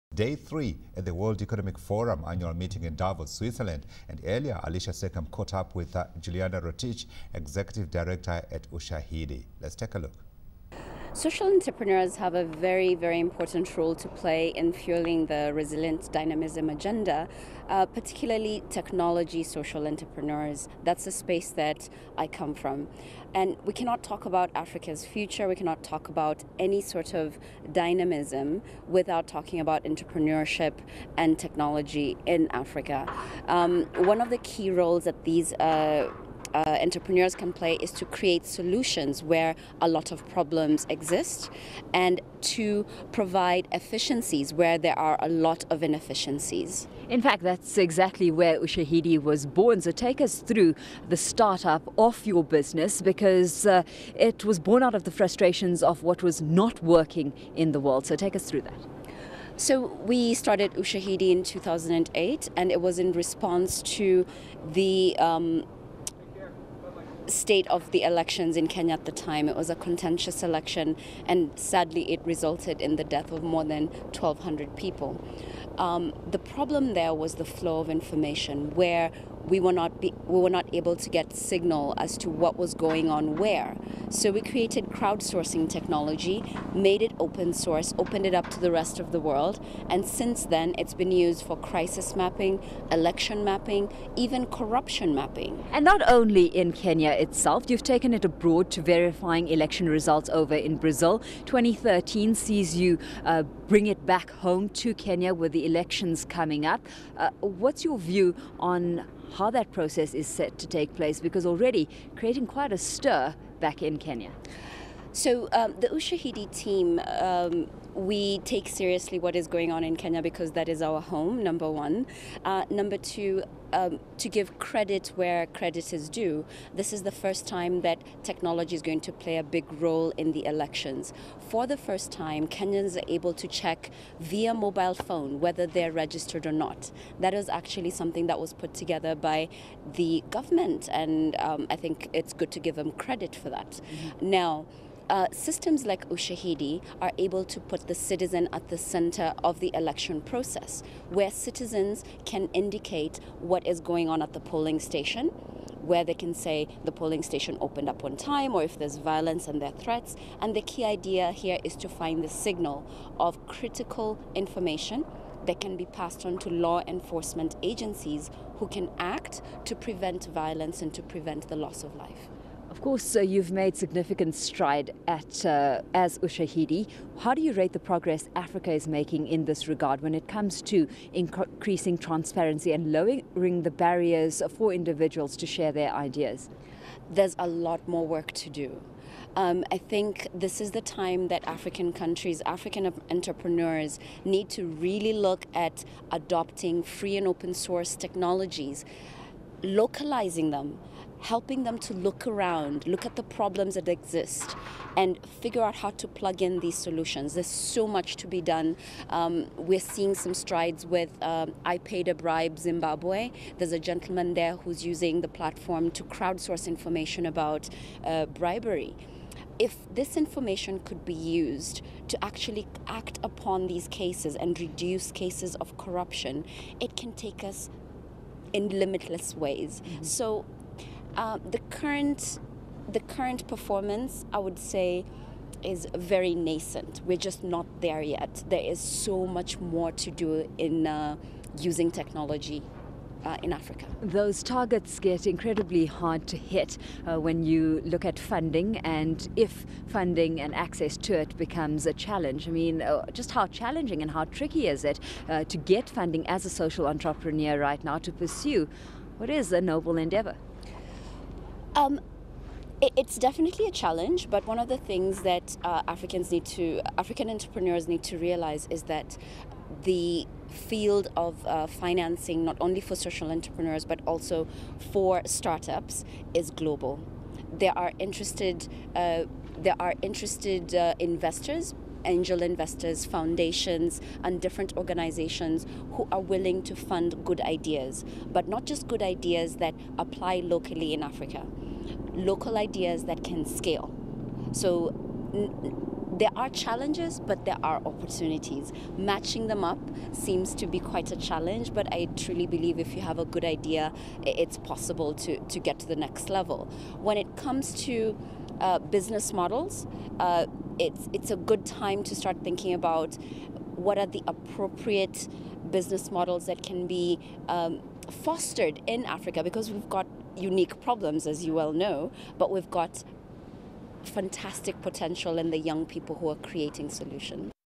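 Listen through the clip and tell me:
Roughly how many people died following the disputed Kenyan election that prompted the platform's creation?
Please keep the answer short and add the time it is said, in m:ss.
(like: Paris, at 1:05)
more than 1,200, at 1:13.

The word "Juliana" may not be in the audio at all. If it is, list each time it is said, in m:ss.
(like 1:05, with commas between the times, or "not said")
0:06.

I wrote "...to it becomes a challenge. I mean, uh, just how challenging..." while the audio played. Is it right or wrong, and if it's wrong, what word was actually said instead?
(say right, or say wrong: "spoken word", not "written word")
right.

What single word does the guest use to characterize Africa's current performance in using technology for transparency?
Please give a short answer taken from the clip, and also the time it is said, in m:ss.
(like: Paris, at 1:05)
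nascent, at 3:56.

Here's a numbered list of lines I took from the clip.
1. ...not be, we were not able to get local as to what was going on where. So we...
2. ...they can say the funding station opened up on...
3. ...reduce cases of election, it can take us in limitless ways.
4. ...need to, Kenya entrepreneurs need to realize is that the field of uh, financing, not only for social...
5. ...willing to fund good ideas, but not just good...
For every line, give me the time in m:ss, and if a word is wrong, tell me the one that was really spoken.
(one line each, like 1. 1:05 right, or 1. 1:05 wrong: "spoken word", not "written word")
1. 1:19 wrong: "signal", not "local"
2. 2:36 wrong: "polling", not "funding"
3. 3:44 wrong: "corruption", not "election"
4. 4:26 wrong: "African", not "Kenya"
5. 4:46 right.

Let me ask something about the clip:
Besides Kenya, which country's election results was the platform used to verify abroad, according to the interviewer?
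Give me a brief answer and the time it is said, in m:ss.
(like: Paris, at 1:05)
Brazil, at 1:40.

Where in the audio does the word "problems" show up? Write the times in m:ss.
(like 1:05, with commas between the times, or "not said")
0:40, 1:16, 3:23, 5:20.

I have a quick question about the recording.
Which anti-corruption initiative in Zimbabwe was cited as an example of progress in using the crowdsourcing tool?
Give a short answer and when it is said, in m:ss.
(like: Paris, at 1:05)
I Paid a Bribe, at 3:31.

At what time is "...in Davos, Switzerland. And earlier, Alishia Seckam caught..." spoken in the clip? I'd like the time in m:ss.
0:02.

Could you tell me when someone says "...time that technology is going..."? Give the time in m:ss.
2:07.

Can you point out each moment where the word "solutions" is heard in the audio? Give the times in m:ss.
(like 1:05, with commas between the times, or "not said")
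0:38, 3:26, 5:26.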